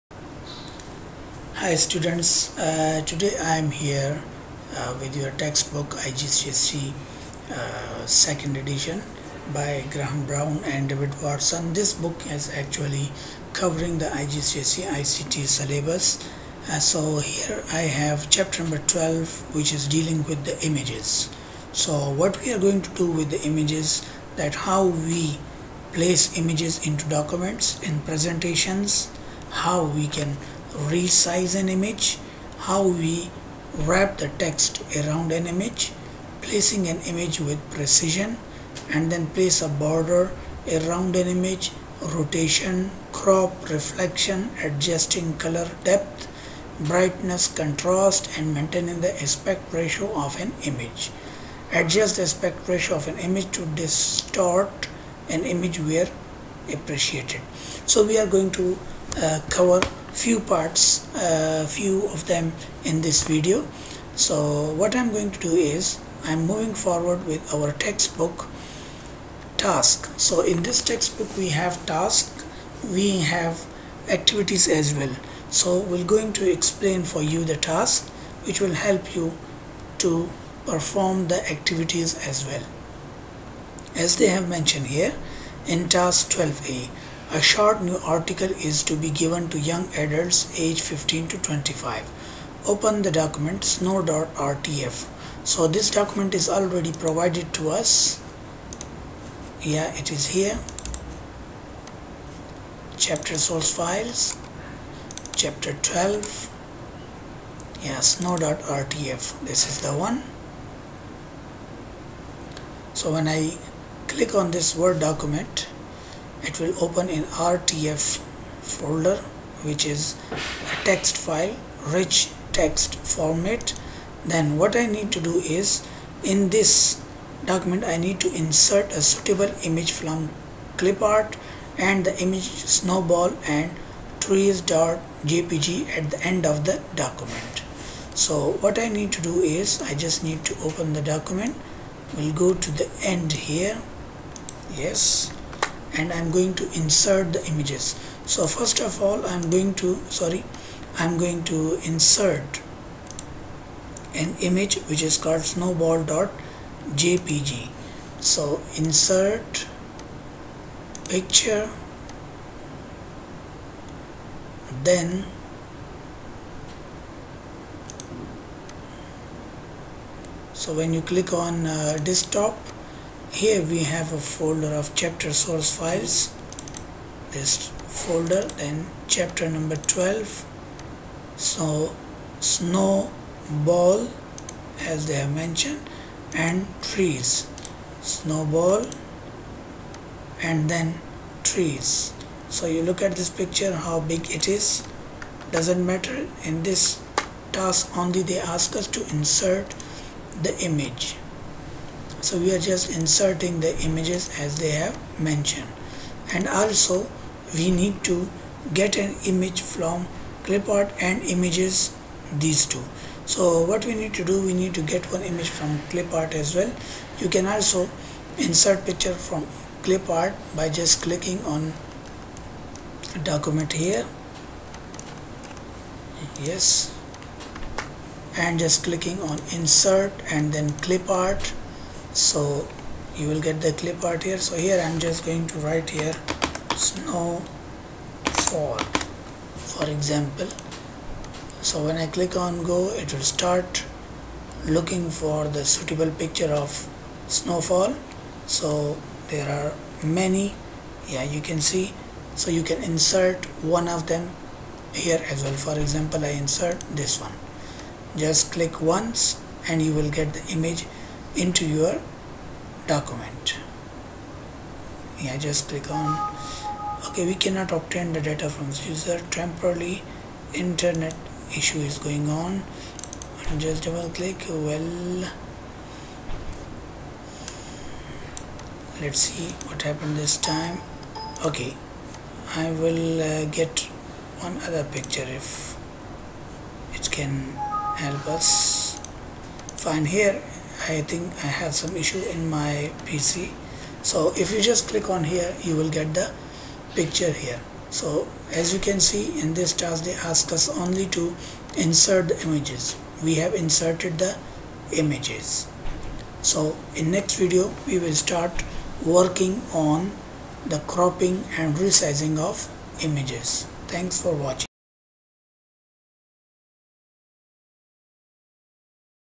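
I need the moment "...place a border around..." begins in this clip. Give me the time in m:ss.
0:39.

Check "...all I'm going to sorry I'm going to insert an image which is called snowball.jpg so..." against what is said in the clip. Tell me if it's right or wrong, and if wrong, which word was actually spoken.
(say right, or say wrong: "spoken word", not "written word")
right.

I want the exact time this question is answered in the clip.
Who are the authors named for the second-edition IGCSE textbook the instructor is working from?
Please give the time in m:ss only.
0:09.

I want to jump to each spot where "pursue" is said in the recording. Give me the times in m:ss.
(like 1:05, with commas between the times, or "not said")
not said.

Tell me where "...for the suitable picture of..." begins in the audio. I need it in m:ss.
4:05.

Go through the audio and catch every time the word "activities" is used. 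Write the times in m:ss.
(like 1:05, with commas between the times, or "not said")
1:14, 1:21.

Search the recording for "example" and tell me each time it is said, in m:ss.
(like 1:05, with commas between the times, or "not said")
3:59, 4:15.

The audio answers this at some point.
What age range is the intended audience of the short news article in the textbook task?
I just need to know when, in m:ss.
1:30.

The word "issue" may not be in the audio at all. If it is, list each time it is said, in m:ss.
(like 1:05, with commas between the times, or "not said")
4:31, 4:51.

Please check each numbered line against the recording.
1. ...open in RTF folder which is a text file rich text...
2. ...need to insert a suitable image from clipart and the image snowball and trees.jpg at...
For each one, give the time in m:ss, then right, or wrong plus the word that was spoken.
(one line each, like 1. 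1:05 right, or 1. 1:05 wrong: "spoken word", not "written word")
1. 1:56 right
2. 2:07 right.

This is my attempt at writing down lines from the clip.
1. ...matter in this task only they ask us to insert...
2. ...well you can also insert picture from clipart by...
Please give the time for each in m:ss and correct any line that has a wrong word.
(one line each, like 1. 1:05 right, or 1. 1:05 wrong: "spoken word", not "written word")
1. 3:15 right
2. 3:36 right.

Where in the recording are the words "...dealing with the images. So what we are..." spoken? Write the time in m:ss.
0:19.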